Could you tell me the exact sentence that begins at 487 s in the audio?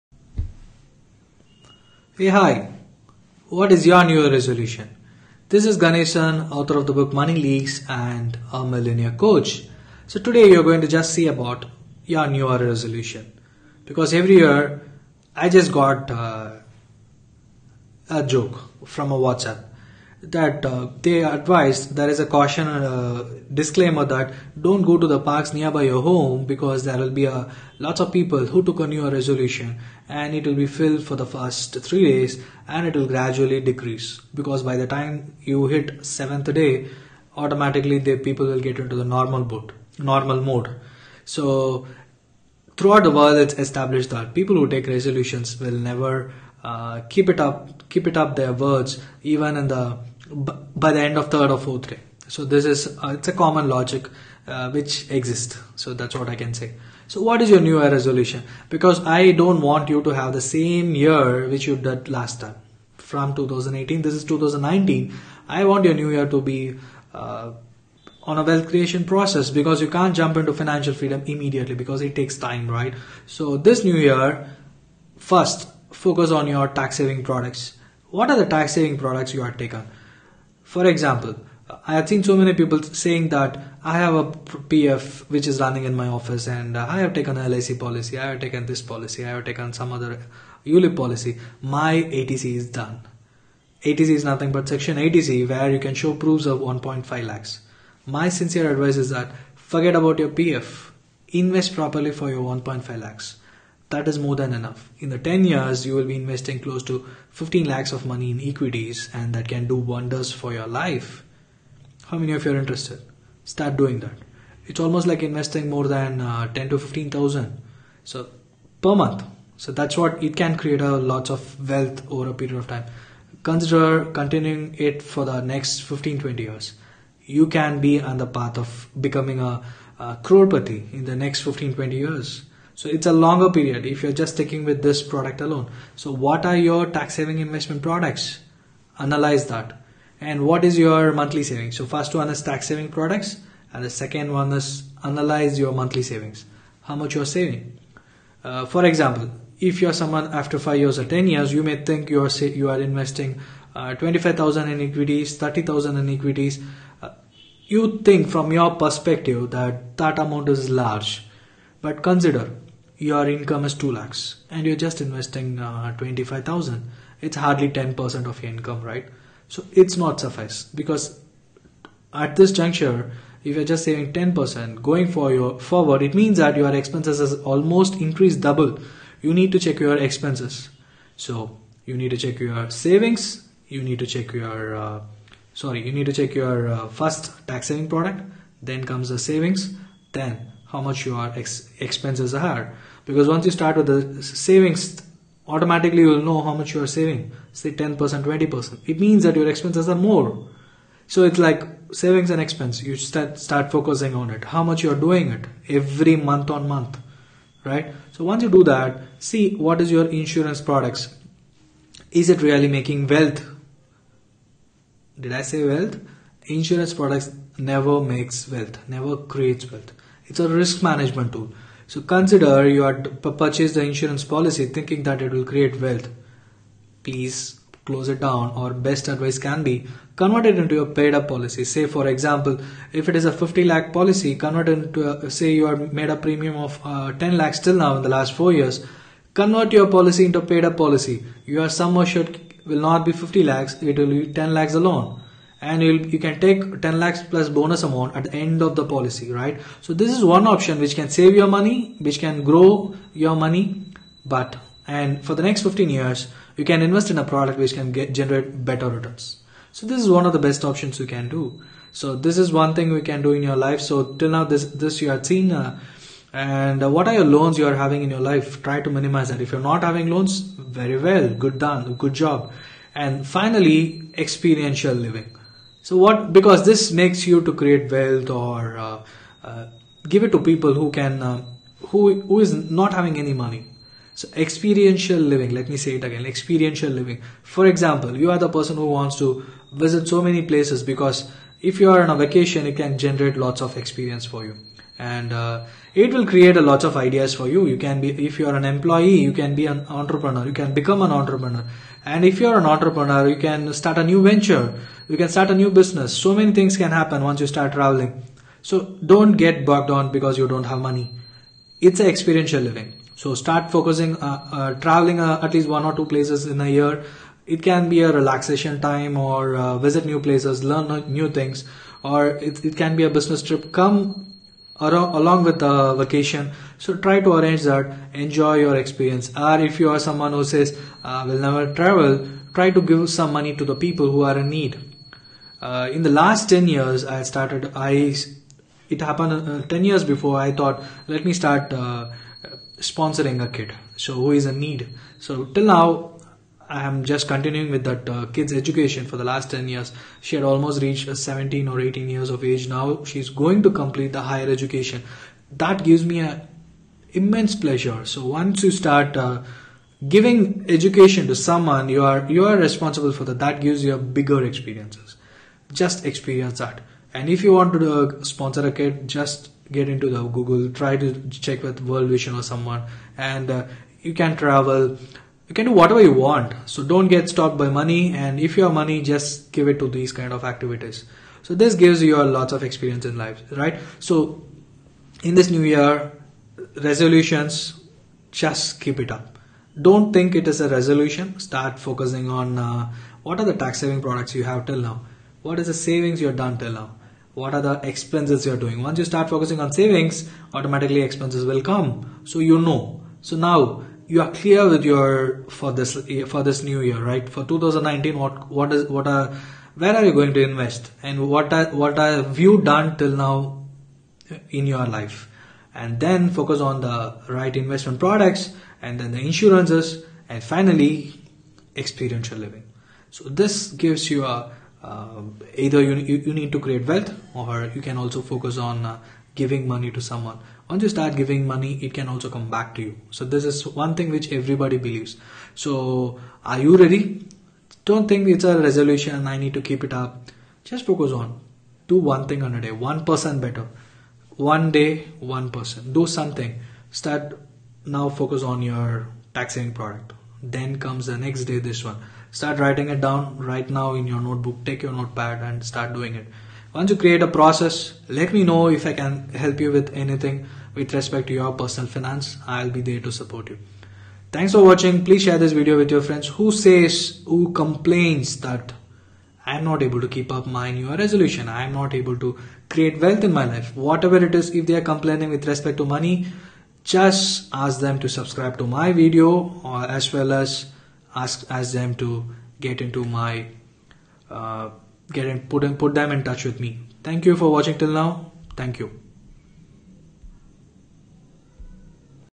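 Thank you for watching till now.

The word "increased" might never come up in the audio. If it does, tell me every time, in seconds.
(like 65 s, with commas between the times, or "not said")
178 s.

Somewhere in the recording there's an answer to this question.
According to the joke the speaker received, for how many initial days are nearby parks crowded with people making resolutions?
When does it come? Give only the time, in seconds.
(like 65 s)
31 s.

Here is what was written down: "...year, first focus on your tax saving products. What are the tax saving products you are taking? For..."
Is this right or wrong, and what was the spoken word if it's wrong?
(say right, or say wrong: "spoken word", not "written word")
right.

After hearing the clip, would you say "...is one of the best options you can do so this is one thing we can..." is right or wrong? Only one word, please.
right.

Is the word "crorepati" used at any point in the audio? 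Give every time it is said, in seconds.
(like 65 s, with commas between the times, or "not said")
130 s.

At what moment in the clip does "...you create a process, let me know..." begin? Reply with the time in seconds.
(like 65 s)
456 s.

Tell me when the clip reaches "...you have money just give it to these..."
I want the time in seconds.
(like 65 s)
378 s.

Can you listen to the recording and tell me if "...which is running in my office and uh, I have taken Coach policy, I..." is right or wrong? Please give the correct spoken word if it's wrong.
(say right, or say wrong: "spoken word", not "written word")
wrong: "LIC", not "Coach".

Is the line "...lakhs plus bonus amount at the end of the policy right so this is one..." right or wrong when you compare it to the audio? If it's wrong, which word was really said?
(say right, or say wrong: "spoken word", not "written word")
right.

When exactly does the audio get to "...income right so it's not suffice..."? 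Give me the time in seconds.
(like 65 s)
168 s.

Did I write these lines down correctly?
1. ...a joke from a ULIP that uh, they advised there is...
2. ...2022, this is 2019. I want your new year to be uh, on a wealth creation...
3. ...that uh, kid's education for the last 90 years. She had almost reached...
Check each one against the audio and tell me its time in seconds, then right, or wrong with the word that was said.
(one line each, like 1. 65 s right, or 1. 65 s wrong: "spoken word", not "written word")
1. 18 s wrong: "WhatsApp", not "ULIP"
2. 63 s wrong: "2018", not "2022"
3. 347 s wrong: "10", not "90".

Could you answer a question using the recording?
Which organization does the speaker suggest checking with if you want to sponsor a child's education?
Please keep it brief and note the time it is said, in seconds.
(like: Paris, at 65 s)
World Vision, at 371 s.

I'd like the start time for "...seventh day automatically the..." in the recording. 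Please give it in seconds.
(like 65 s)
36 s.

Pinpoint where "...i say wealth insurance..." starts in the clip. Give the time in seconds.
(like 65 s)
215 s.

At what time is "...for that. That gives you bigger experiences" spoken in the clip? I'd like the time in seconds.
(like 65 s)
363 s.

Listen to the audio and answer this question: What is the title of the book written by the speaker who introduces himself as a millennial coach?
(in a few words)
Money Leaks.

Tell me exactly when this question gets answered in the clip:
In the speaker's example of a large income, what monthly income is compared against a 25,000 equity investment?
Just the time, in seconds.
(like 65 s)
163 s.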